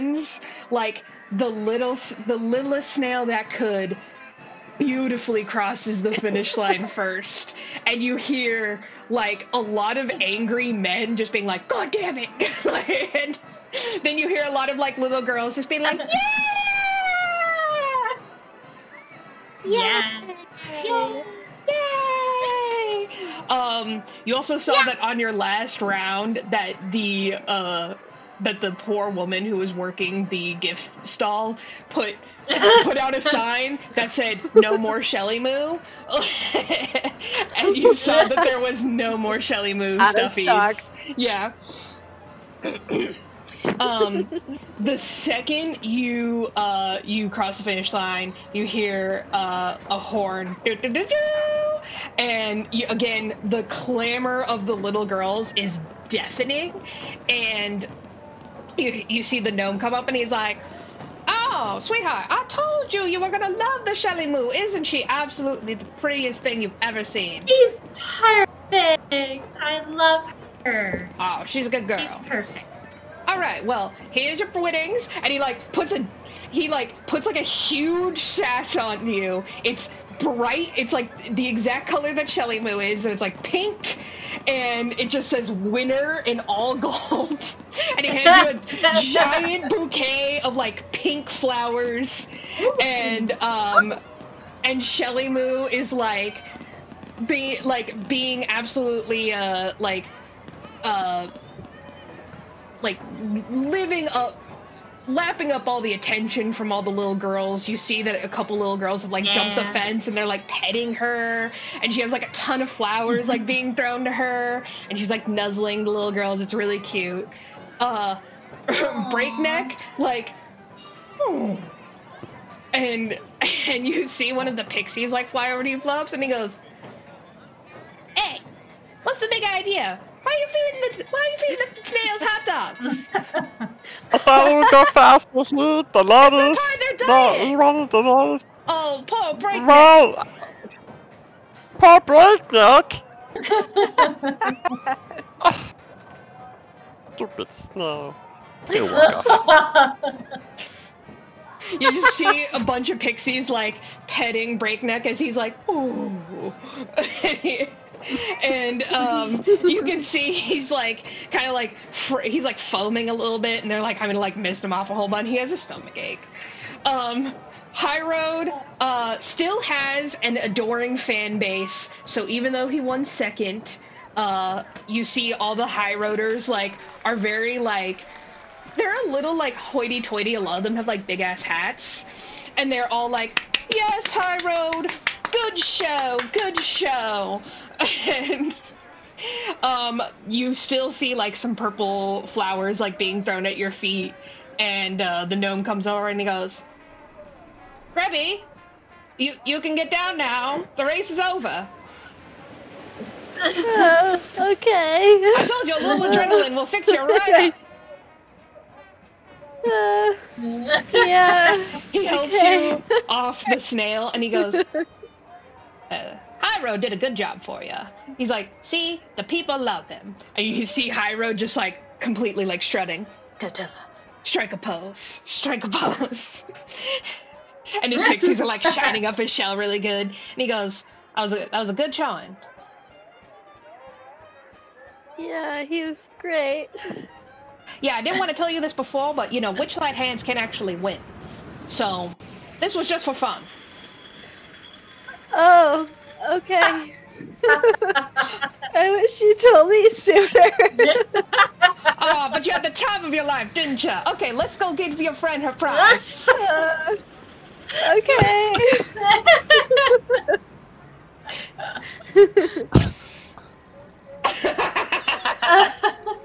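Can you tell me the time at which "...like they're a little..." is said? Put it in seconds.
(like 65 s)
177 s.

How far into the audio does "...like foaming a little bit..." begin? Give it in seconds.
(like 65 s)
162 s.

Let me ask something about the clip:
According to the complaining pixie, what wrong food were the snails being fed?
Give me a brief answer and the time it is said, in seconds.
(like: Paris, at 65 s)
Hot dogs, at 132 s.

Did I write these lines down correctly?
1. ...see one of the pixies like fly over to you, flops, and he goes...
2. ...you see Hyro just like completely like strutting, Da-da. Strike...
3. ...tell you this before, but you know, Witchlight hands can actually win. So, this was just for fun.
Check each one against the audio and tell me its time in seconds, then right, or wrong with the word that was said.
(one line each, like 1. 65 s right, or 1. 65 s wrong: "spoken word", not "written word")
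1. 124 s right
2. 220 s right
3. 238 s right.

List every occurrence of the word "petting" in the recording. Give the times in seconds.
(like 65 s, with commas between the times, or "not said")
110 s, 154 s.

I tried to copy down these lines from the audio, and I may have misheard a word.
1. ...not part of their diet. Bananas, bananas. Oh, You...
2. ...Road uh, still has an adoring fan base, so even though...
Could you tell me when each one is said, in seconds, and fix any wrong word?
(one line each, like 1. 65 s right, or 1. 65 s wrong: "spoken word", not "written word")
1. 136 s wrong: "Paul", not "You"
2. 168 s right.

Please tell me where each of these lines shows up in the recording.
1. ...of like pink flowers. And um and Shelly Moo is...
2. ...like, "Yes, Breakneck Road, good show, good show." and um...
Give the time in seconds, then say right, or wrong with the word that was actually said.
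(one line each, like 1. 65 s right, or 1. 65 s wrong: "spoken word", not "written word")
1. 90 s right
2. 183 s wrong: "High", not "Breakneck".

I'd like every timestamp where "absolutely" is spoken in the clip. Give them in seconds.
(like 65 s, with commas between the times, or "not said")
65 s, 98 s.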